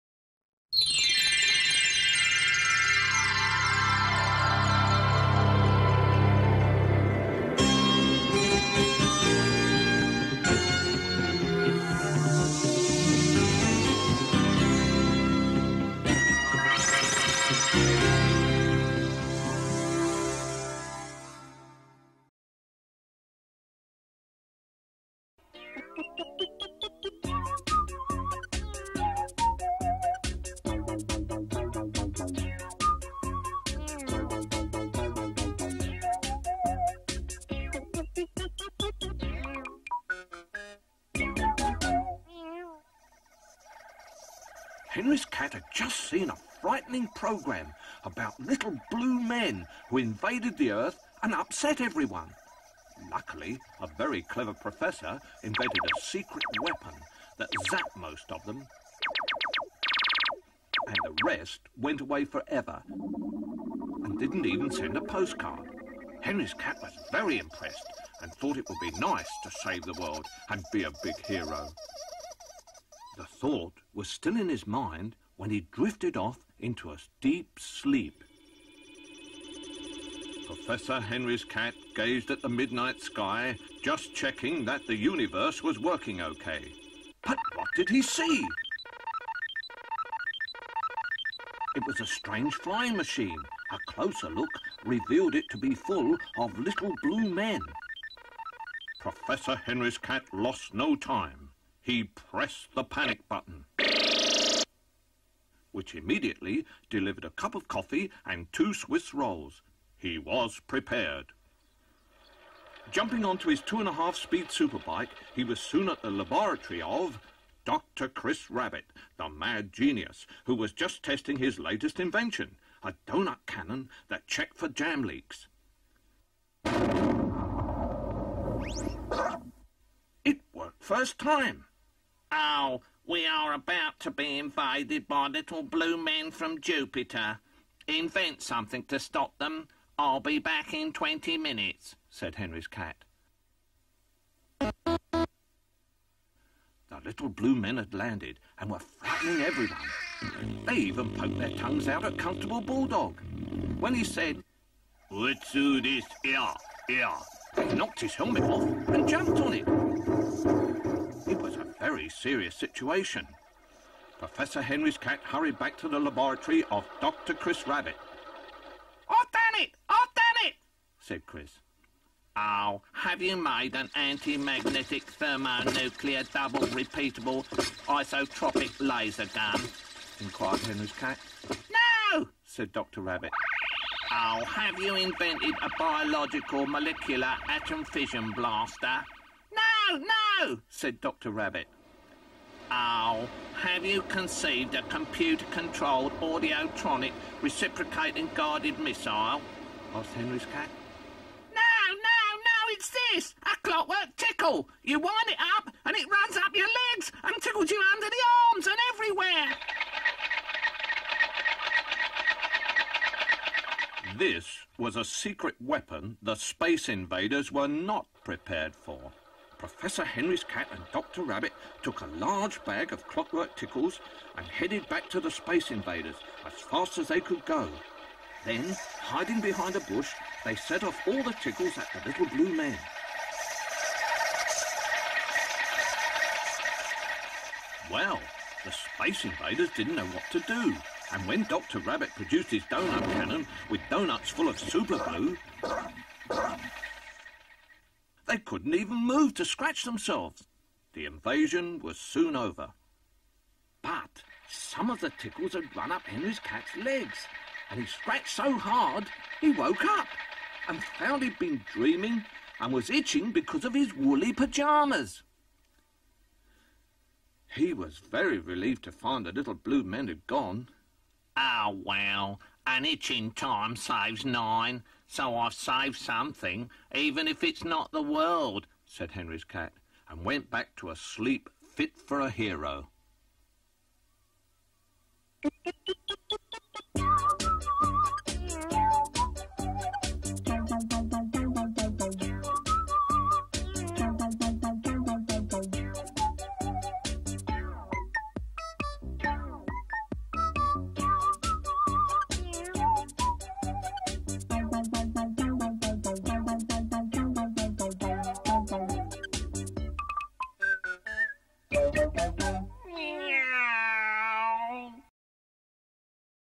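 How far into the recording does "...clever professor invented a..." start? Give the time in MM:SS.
00:54.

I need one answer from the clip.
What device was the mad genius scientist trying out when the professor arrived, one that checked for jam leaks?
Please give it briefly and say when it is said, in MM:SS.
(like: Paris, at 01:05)
A donut cannon, at 02:02.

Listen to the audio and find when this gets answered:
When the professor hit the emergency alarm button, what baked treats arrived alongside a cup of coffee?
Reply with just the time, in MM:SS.
01:48.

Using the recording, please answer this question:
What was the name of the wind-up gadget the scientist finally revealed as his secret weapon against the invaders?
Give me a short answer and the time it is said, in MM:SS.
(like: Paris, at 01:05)
A clockwork tickle, at 03:23.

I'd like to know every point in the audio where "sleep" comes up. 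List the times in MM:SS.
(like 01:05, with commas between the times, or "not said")
01:17, 04:40.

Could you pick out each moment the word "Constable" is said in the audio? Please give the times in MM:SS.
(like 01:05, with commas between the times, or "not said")
02:32.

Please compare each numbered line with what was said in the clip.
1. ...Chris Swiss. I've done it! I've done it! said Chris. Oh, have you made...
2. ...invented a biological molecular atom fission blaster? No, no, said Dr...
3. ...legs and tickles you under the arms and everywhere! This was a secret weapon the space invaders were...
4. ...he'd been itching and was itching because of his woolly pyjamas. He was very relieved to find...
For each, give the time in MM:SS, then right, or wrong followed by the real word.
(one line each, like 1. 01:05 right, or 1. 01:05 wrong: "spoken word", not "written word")
1. 02:47 wrong: "Rabbit", not "Swiss"
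2. 03:04 right
3. 03:26 right
4. 04:21 wrong: "dreaming", not "itching".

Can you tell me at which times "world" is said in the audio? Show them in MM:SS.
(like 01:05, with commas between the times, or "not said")
01:10, 04:38.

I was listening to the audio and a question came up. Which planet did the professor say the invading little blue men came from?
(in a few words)
Jupiter.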